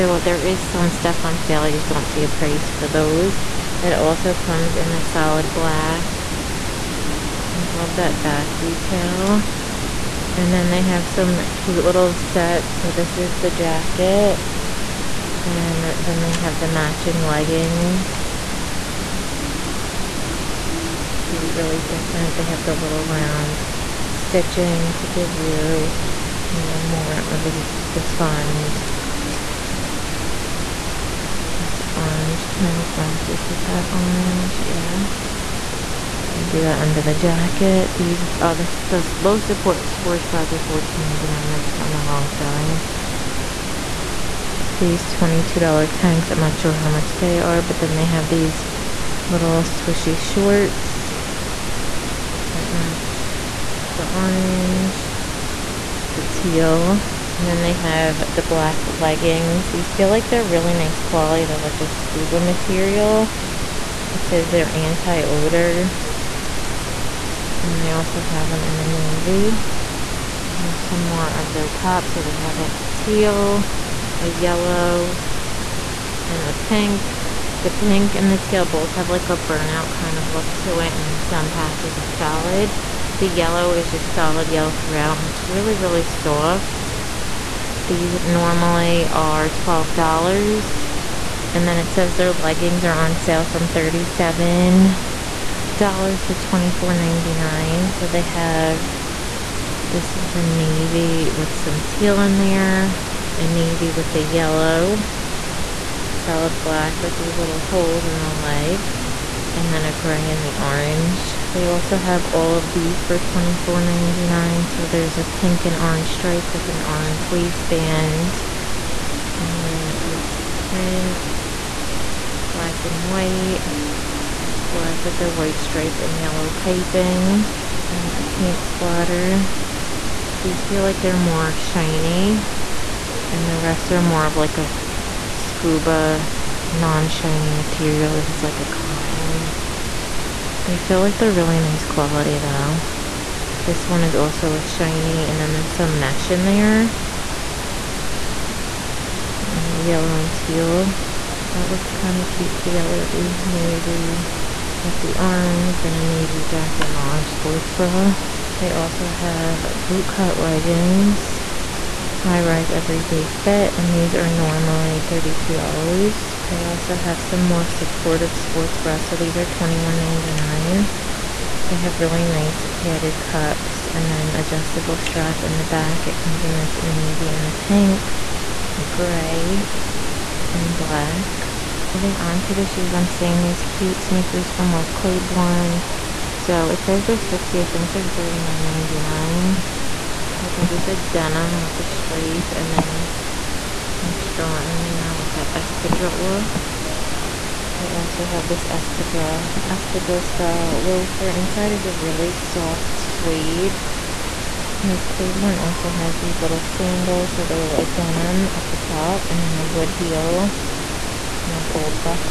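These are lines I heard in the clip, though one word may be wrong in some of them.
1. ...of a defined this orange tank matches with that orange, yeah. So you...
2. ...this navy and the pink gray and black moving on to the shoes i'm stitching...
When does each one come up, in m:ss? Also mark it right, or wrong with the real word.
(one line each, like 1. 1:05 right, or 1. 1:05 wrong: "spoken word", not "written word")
1. 0:27 right
2. 2:56 wrong: "seeing", not "stitching".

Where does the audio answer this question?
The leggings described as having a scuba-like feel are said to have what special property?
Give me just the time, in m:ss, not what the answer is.
1:04.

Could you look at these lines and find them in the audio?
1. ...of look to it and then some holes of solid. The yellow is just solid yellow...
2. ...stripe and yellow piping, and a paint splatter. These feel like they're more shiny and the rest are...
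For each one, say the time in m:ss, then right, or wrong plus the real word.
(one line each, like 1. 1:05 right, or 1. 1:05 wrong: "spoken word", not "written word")
1. 1:20 wrong: "patches", not "holes"
2. 2:05 right.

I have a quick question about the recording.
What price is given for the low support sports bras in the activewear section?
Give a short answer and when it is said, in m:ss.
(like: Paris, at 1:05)
$14.99, at 0:40.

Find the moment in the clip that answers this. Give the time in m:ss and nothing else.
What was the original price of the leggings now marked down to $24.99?
1:33.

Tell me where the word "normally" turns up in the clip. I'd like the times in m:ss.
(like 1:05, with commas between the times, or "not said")
1:28, 2:44.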